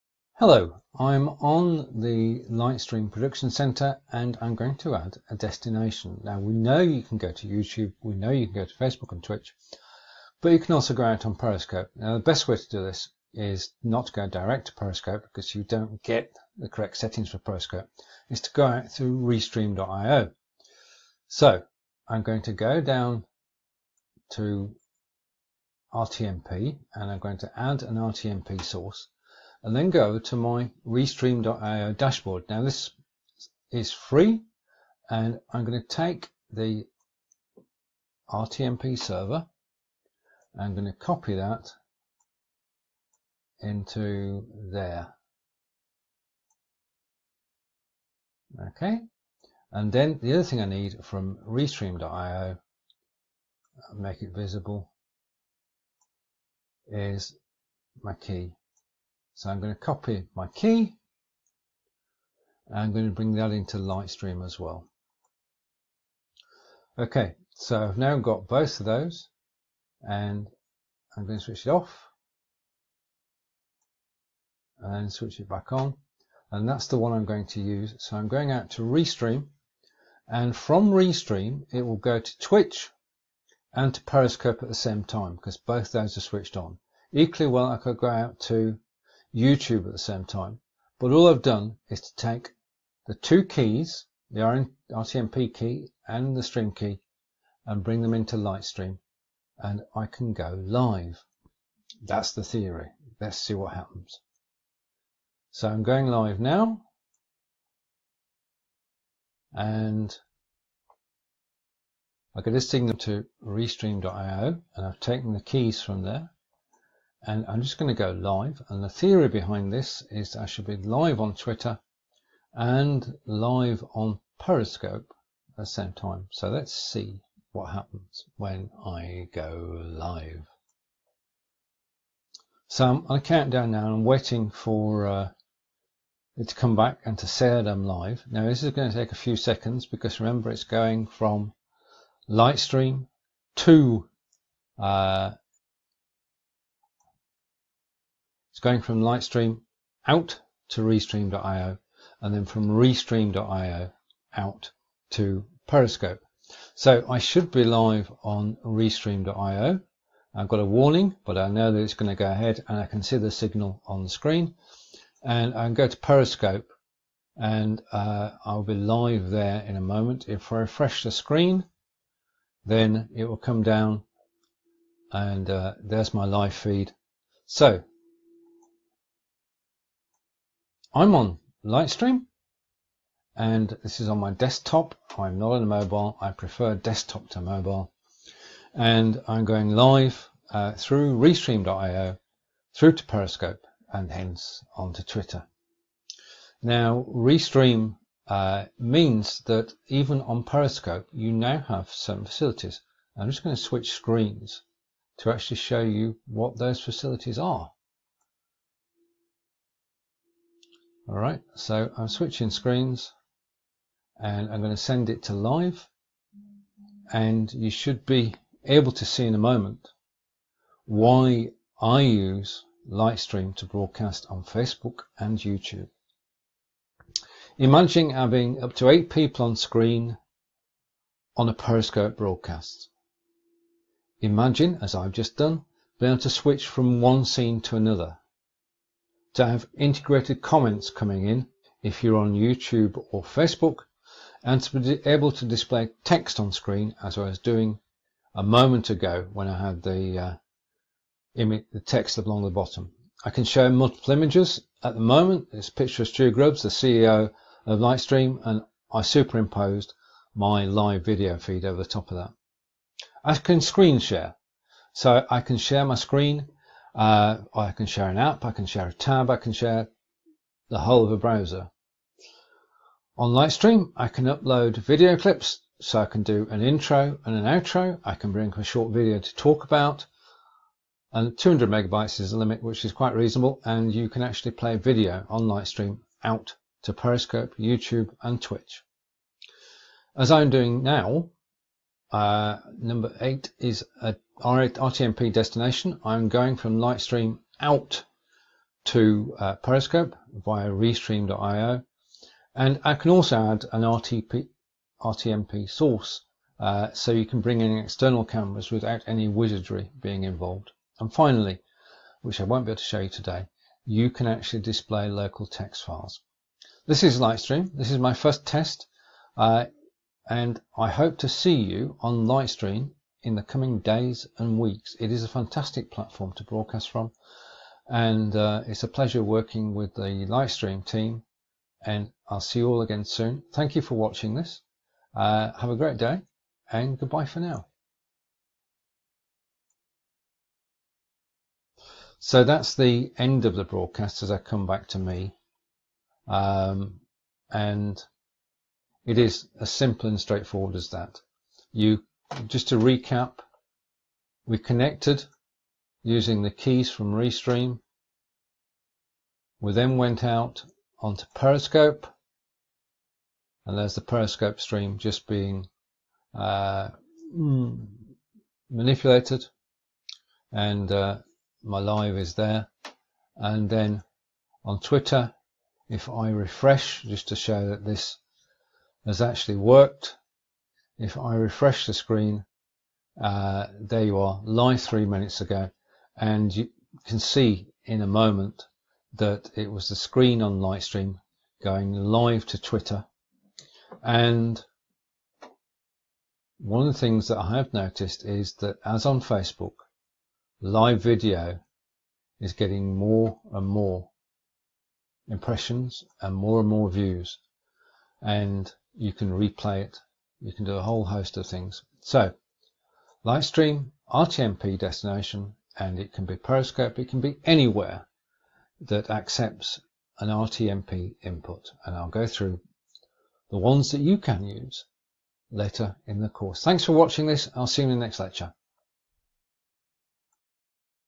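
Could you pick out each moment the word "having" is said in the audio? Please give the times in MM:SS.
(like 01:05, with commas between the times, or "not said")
03:48.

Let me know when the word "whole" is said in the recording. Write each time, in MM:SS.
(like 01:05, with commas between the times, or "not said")
04:30, 06:50.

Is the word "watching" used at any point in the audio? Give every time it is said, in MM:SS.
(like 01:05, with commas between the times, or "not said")
05:33, 07:06.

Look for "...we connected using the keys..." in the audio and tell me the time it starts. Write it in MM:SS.
05:54.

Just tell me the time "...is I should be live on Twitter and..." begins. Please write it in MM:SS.
02:00.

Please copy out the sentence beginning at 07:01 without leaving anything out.
And I'll go through the ones that you can use later in the course.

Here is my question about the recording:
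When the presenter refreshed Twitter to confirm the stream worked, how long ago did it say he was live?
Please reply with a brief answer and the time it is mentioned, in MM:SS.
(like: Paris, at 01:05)
3 minutes ago, at 06:24.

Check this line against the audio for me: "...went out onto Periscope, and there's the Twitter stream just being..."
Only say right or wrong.
wrong.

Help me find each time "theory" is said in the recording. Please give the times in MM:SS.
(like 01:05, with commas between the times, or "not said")
01:42, 01:58.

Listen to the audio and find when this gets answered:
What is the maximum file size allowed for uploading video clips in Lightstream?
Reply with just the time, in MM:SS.
04:41.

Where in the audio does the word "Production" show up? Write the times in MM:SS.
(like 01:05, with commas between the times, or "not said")
00:03.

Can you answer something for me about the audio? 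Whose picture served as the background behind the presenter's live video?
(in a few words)
Stu Grubbs.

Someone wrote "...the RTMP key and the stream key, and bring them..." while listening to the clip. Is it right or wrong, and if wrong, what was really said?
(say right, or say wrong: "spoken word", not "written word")
right.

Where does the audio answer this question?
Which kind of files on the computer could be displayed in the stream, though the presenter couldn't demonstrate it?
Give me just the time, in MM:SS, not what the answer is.
05:15.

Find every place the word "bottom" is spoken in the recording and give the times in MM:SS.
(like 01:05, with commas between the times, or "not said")
04:12.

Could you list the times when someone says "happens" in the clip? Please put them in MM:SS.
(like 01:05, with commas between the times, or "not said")
01:43, 02:07.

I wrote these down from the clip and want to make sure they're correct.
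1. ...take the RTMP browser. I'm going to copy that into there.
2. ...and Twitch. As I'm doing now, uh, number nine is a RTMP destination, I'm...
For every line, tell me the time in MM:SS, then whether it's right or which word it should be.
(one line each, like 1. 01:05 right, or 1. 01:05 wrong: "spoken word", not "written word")
1. 00:35 wrong: "server", not "browser"
2. 04:48 wrong: "eight", not "nine".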